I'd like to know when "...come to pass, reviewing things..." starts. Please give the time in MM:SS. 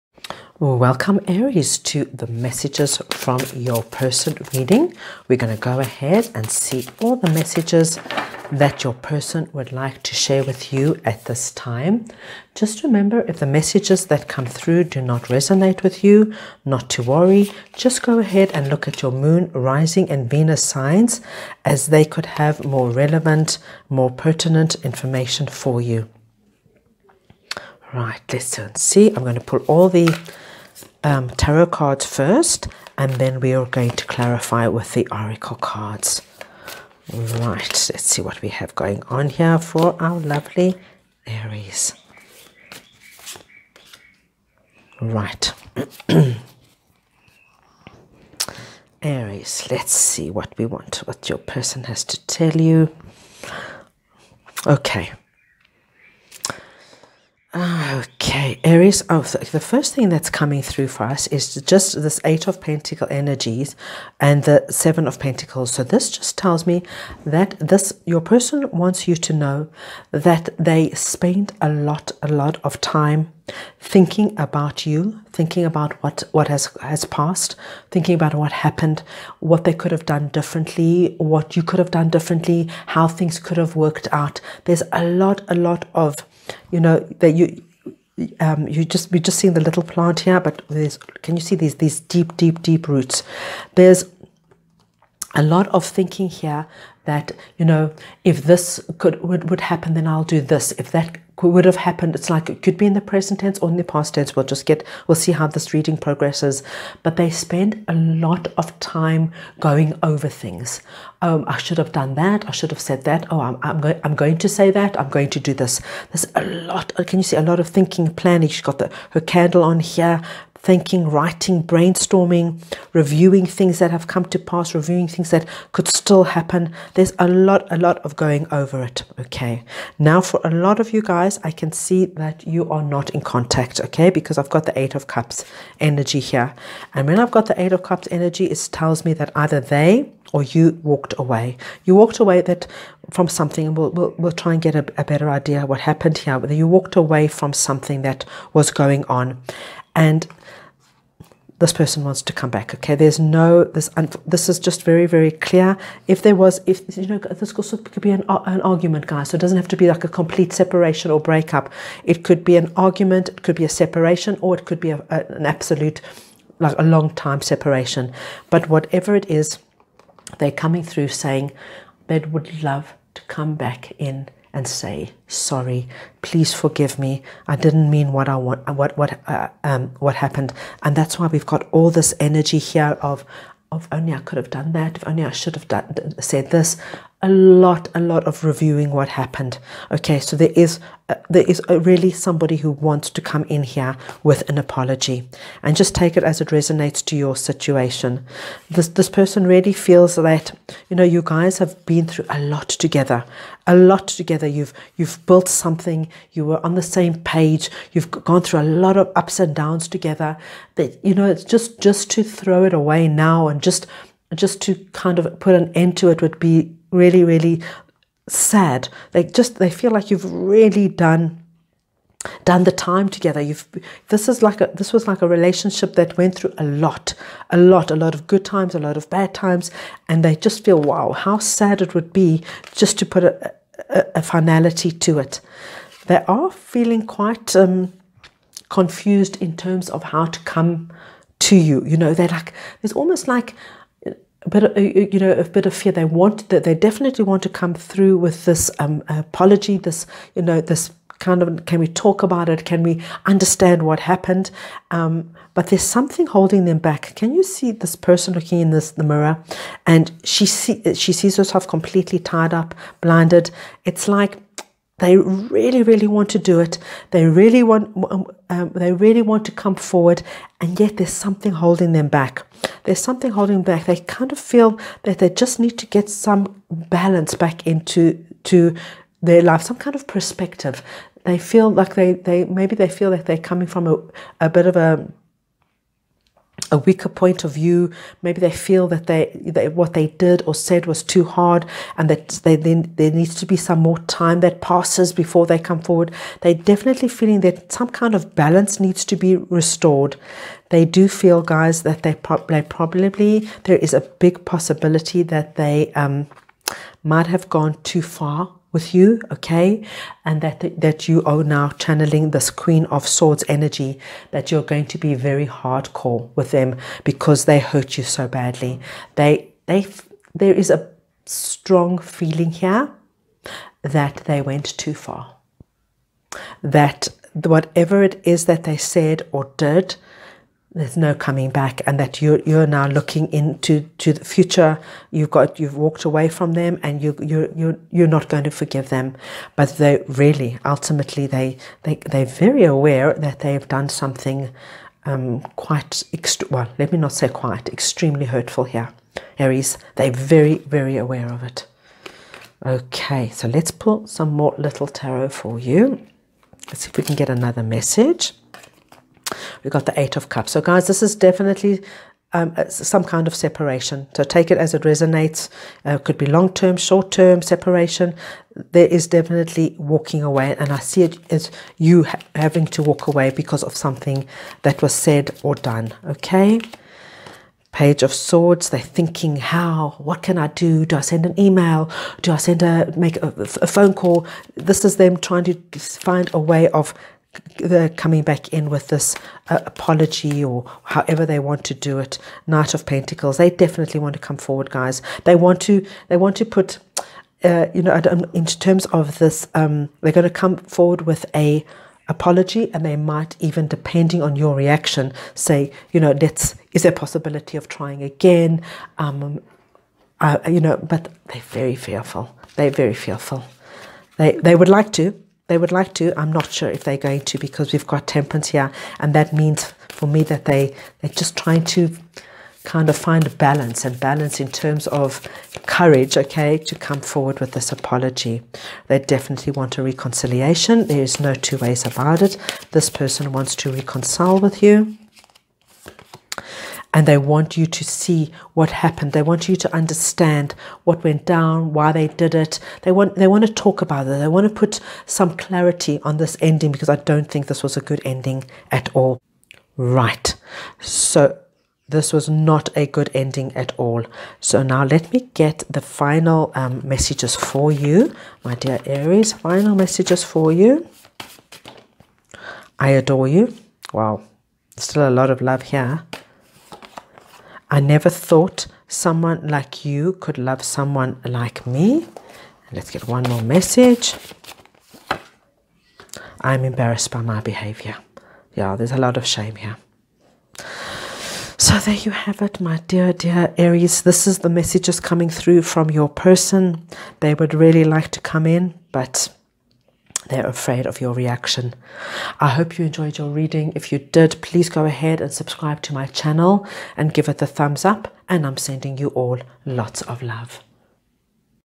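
02:04.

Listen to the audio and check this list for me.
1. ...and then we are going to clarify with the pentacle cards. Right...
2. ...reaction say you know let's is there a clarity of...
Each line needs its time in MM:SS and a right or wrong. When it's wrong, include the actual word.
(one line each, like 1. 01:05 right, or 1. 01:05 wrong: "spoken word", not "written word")
1. 00:32 wrong: "oracle", not "pentacle"
2. 06:44 wrong: "possibility", not "clarity".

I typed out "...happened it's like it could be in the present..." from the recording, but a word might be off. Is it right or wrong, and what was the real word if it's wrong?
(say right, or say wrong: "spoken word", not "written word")
right.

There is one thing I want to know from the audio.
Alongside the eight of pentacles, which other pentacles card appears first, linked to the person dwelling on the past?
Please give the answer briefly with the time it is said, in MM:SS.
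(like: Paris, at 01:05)
Seven of Pentacles, at 01:04.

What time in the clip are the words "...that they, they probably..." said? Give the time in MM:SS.
05:01.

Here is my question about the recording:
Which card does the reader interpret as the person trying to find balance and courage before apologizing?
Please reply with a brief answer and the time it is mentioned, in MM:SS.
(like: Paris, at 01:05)
Temperance, at 06:58.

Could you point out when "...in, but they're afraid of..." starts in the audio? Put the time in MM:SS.
08:08.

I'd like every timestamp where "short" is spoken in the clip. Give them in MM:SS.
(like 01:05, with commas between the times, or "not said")
06:06.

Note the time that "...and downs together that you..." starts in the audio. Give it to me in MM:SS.
03:29.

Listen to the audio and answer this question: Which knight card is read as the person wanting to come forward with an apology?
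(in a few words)
Knight of Pentacles.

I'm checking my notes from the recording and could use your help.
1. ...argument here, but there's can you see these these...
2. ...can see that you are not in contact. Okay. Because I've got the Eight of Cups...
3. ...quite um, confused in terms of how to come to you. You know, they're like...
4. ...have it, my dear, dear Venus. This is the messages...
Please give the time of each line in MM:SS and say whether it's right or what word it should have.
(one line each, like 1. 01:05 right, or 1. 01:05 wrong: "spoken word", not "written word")
1. 01:29 wrong: "plant", not "argument"
2. 02:11 right
3. 03:57 right
4. 08:02 wrong: "Aries", not "Venus".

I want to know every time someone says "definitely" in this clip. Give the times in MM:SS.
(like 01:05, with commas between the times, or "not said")
04:06, 04:56, 06:01, 06:09, 06:33, 07:08.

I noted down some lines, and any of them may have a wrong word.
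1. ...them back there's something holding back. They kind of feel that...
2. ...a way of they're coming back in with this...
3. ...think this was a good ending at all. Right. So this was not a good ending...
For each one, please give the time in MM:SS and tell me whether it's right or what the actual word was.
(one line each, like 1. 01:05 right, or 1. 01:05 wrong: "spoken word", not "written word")
1. 04:31 right
2. 06:26 right
3. 07:27 right.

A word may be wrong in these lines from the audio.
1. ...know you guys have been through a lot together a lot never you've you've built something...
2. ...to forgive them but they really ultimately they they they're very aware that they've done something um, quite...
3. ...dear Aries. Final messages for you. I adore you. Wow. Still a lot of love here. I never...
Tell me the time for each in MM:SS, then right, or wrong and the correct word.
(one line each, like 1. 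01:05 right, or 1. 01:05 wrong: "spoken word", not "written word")
1. 03:20 wrong: "together", not "never"
2. 05:38 right
3. 07:38 right.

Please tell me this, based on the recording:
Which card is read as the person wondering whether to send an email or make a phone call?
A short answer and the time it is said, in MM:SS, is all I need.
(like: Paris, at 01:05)
Page of Swords, at 06:17.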